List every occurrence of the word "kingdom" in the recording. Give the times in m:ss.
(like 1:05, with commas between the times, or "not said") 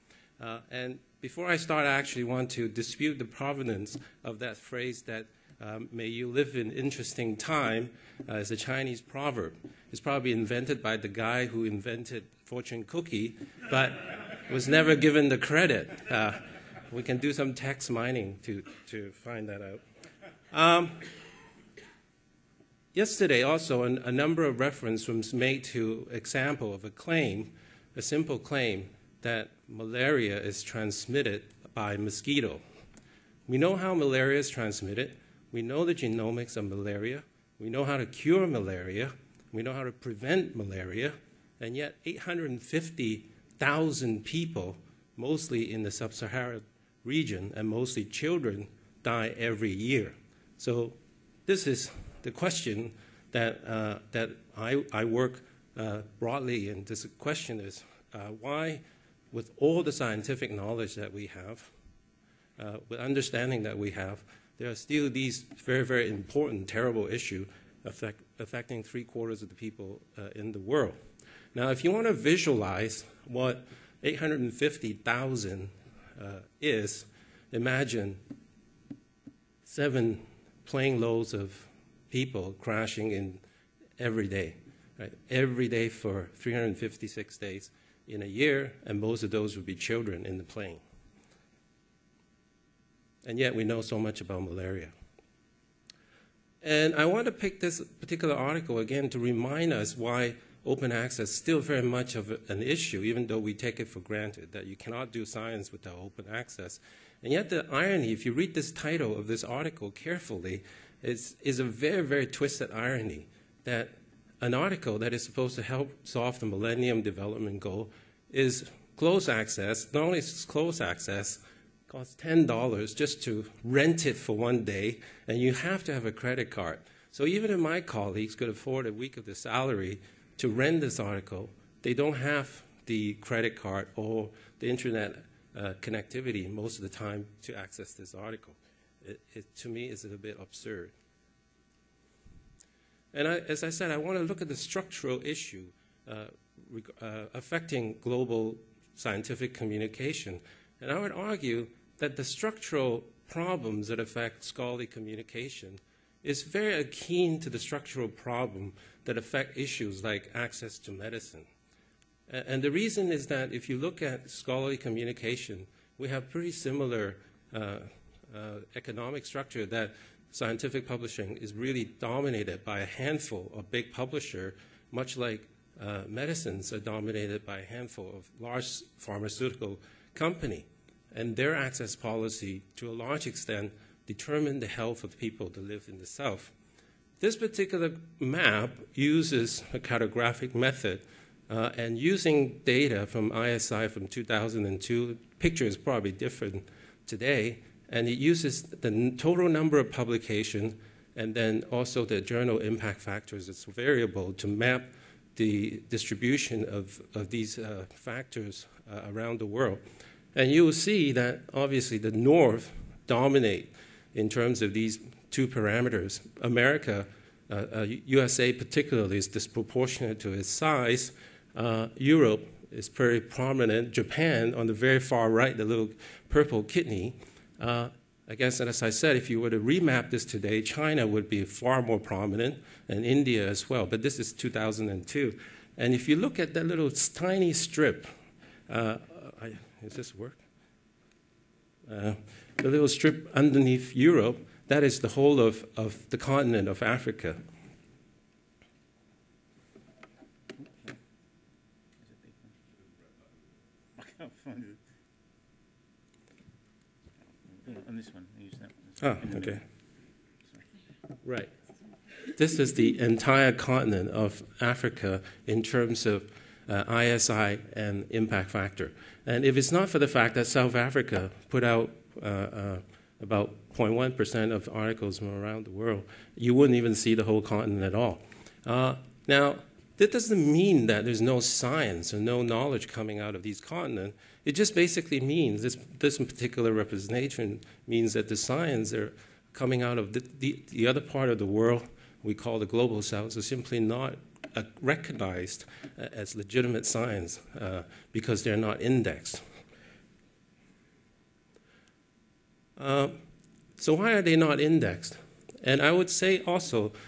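not said.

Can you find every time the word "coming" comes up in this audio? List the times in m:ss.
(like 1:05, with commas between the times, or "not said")
4:42, 4:49.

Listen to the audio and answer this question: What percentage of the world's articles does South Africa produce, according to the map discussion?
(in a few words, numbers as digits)
0.1%.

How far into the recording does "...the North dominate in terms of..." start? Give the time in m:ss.
3:31.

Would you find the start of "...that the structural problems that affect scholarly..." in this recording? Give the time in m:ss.
2:31.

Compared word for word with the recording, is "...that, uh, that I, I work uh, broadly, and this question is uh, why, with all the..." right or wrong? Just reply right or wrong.
right.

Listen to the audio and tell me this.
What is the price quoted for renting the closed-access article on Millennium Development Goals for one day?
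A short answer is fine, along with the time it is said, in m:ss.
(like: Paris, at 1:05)
$10, at 2:02.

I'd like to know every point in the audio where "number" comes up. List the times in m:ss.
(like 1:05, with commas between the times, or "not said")
0:24, 3:19.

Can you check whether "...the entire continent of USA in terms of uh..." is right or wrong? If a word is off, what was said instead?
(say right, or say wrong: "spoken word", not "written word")
wrong: "Africa", not "USA".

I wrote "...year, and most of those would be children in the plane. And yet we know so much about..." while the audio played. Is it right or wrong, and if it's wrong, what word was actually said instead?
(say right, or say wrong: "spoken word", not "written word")
right.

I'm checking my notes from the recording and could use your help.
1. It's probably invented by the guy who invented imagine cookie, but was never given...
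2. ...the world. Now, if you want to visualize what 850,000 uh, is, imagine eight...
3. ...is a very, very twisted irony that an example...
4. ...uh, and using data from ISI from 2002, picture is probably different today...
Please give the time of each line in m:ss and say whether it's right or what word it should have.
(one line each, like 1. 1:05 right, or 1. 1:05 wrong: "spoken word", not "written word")
1. 0:09 wrong: "fortune", not "imagine"
2. 1:10 wrong: "seven", not "eight"
3. 1:51 wrong: "article", not "example"
4. 3:11 right.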